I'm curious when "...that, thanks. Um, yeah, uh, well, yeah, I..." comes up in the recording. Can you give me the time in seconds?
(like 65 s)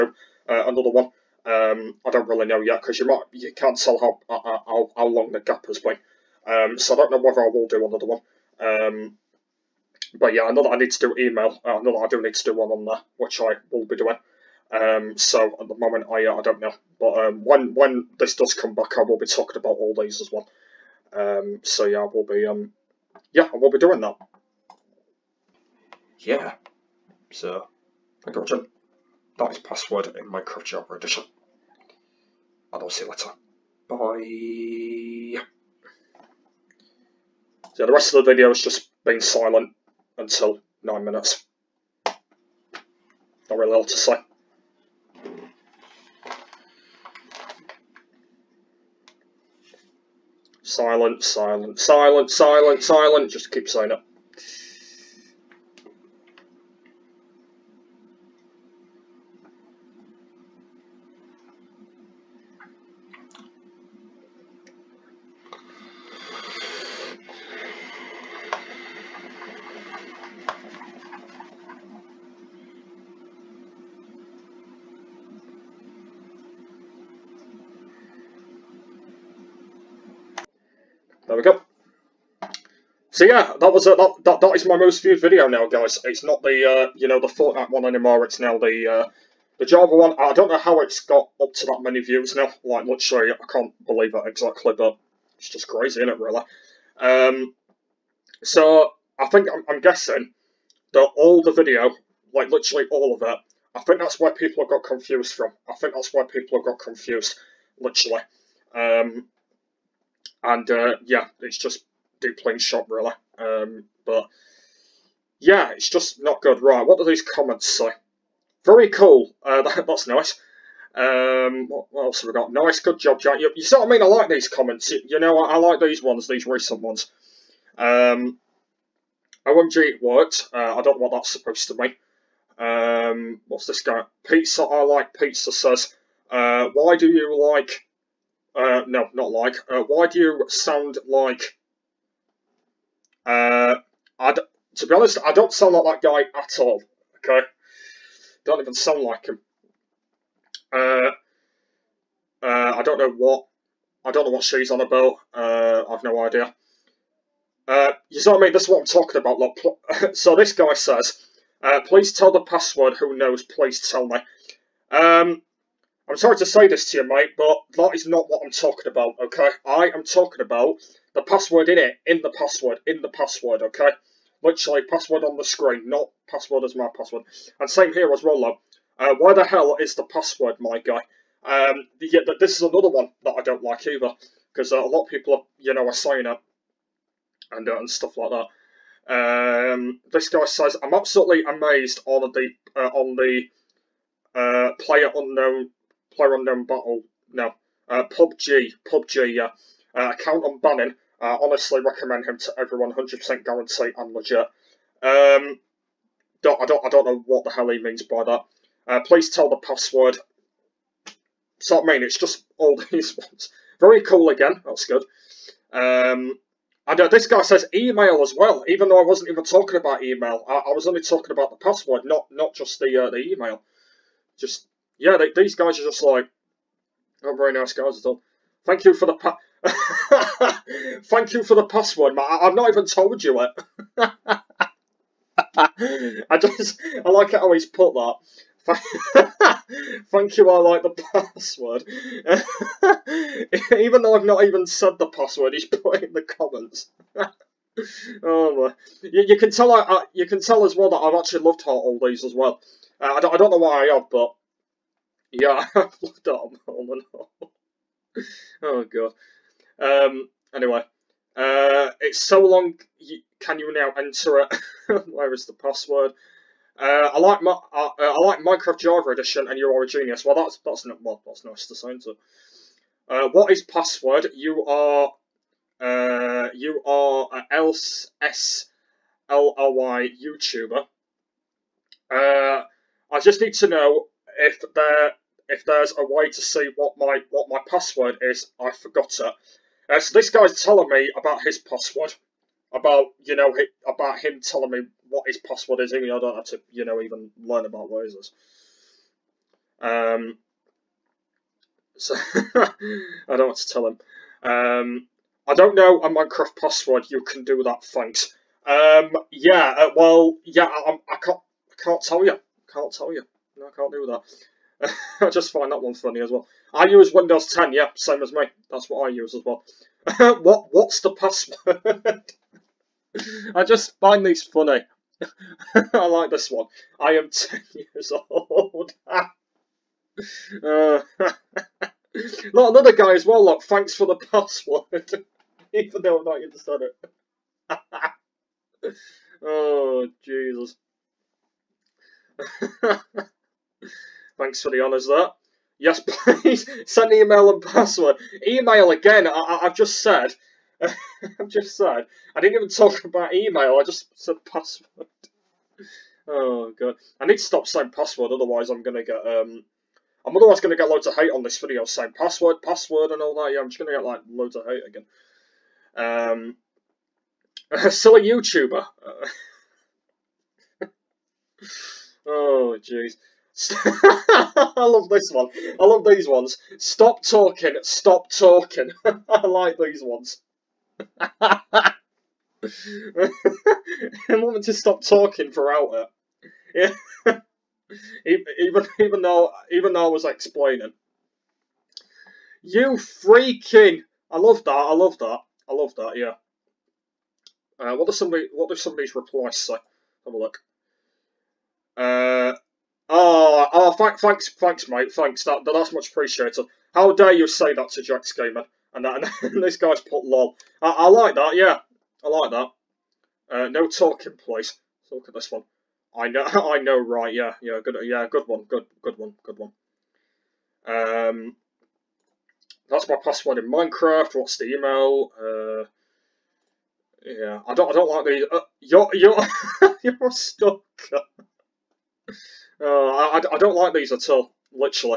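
307 s.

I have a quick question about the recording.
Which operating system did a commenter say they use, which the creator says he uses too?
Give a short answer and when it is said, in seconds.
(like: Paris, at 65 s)
Windows 10, at 317 s.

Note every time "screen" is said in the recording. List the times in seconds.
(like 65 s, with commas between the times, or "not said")
175 s.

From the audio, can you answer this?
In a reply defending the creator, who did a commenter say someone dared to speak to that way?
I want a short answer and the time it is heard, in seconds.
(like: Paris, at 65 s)
Jack Gamer, at 408 s.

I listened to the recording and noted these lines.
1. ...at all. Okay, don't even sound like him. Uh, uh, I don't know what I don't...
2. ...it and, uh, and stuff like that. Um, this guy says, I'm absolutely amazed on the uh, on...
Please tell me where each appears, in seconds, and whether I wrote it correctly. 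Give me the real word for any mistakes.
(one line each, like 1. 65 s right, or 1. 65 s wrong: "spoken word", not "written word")
1. 146 s right
2. 186 s right.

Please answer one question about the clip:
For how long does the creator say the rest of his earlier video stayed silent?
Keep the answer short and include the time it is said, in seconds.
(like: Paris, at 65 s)
9 minutes, at 40 s.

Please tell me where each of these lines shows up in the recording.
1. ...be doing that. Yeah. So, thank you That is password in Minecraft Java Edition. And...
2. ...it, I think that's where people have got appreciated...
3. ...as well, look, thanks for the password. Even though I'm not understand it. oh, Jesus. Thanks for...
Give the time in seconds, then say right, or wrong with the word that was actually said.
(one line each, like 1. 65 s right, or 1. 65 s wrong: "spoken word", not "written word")
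1. 23 s right
2. 103 s wrong: "confused", not "appreciated"
3. 333 s right.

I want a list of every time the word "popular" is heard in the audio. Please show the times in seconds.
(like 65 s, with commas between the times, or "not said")
not said.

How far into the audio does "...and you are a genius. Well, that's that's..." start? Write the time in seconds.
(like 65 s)
269 s.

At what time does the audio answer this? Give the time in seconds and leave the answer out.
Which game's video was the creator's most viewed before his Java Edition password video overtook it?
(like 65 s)
87 s.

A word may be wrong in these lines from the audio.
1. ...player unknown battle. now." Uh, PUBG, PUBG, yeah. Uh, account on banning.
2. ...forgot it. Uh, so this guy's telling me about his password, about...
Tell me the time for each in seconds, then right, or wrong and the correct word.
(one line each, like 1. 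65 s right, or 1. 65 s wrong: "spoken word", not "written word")
1. 196 s right
2. 288 s right.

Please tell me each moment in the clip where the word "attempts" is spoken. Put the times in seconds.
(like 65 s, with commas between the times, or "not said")
not said.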